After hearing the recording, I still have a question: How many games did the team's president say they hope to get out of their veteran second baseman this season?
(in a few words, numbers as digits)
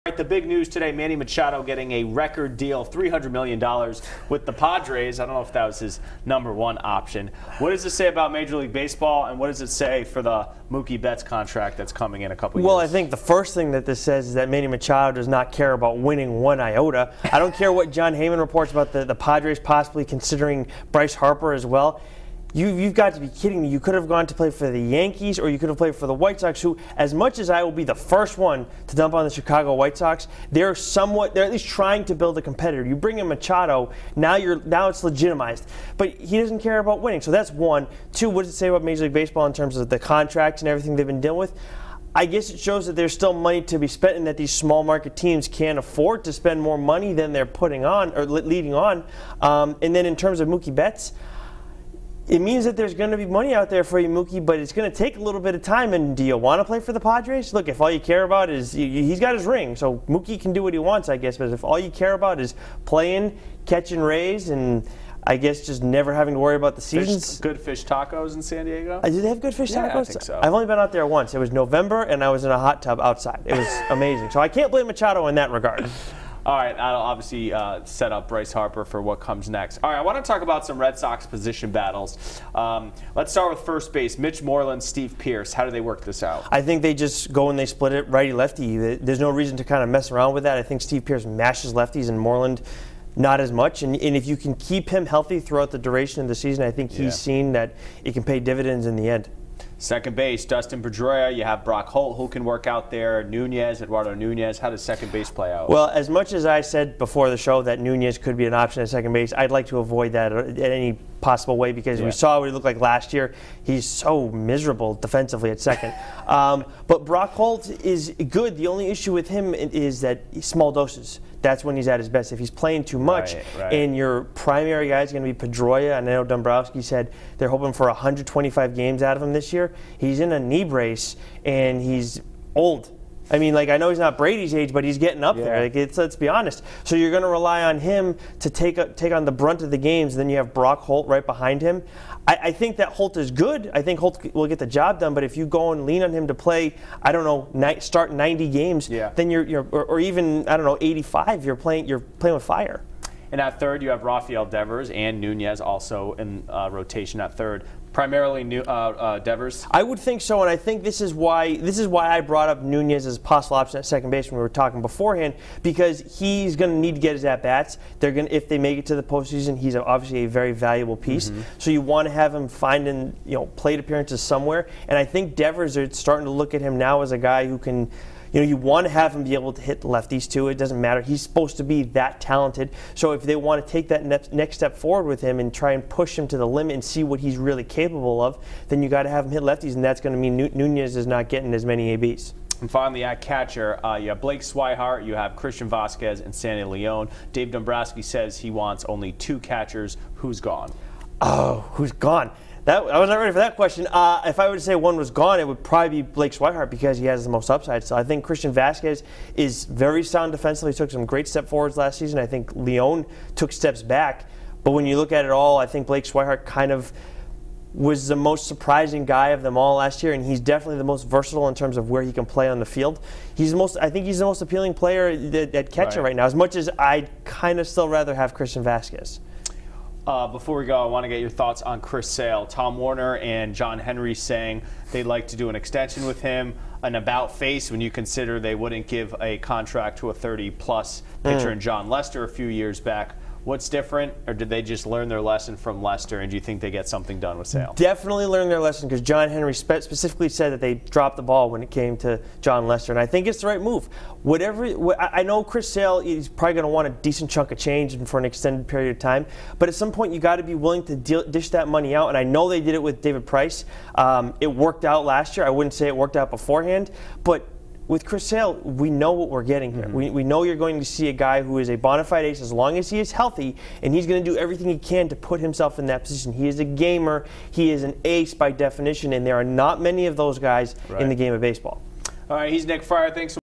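125.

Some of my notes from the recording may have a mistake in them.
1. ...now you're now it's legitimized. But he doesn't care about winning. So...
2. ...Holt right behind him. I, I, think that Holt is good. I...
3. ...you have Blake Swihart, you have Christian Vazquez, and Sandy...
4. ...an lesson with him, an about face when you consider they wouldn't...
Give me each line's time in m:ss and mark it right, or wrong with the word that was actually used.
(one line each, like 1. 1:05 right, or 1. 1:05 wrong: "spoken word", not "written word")
1. 0:34 right
2. 2:20 right
3. 3:13 right
4. 3:55 wrong: "extension", not "lesson".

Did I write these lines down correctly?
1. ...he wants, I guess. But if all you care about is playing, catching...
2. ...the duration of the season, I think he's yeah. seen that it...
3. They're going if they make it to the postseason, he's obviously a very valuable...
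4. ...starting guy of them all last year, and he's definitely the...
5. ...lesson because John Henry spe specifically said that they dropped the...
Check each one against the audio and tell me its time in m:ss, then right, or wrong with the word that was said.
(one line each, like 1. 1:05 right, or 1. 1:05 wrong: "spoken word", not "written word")
1. 1:00 right
2. 1:35 right
3. 2:47 right
4. 3:38 wrong: "surprising", not "starting"
5. 4:08 right.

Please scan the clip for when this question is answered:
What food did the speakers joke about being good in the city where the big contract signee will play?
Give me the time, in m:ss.
1:07.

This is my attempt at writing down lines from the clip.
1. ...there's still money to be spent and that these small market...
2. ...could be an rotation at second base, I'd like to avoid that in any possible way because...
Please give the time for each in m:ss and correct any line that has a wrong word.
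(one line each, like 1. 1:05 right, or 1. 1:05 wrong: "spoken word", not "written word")
1. 0:42 right
2. 1:48 wrong: "option", not "rotation".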